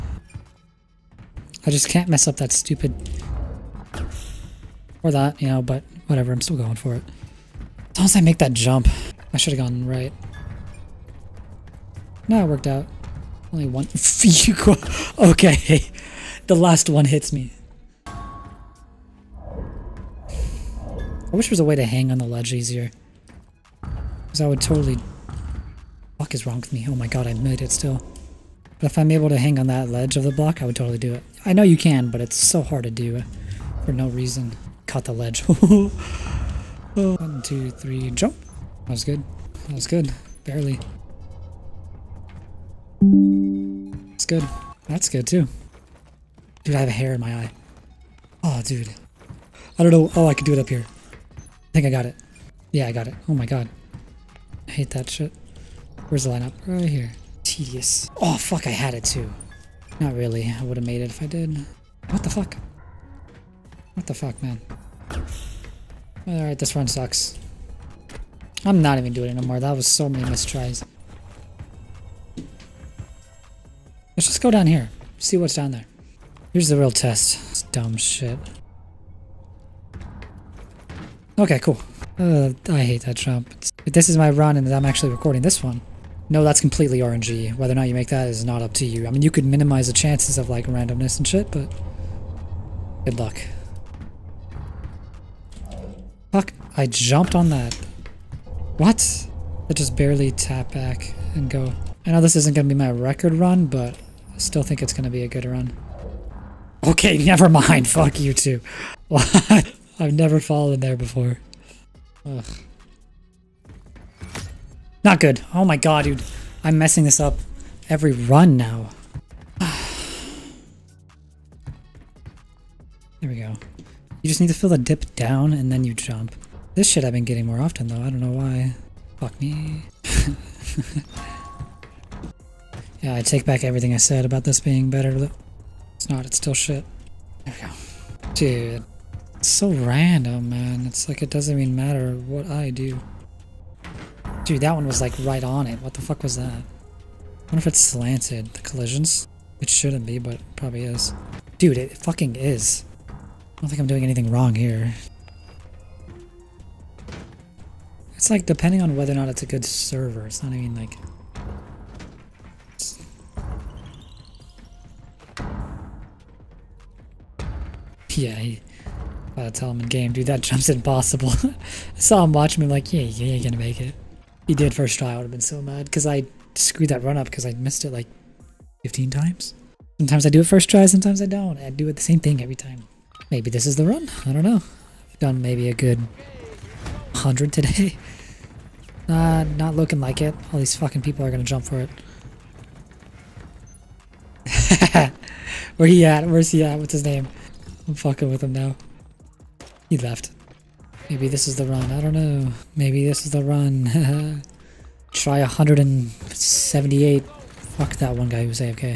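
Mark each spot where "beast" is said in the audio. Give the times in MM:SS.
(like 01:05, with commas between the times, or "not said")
not said.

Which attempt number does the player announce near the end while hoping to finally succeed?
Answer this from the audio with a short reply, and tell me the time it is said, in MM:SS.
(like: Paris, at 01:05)
178, at 03:25.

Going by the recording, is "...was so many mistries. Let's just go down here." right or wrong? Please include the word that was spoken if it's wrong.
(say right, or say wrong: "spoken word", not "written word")
right.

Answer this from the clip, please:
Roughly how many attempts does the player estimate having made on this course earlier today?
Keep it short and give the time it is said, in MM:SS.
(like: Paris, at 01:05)
100, at 03:07.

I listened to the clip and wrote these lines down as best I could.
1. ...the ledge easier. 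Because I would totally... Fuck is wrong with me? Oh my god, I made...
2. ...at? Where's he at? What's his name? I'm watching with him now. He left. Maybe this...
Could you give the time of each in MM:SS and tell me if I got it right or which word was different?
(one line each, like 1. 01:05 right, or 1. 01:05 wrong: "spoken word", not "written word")
1. 00:22 right
2. 03:16 wrong: "fucking", not "watching".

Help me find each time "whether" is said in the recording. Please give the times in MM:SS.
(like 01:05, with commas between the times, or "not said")
01:27, 02:38.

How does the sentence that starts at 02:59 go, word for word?
Sometimes I do it first try, sometimes I don't.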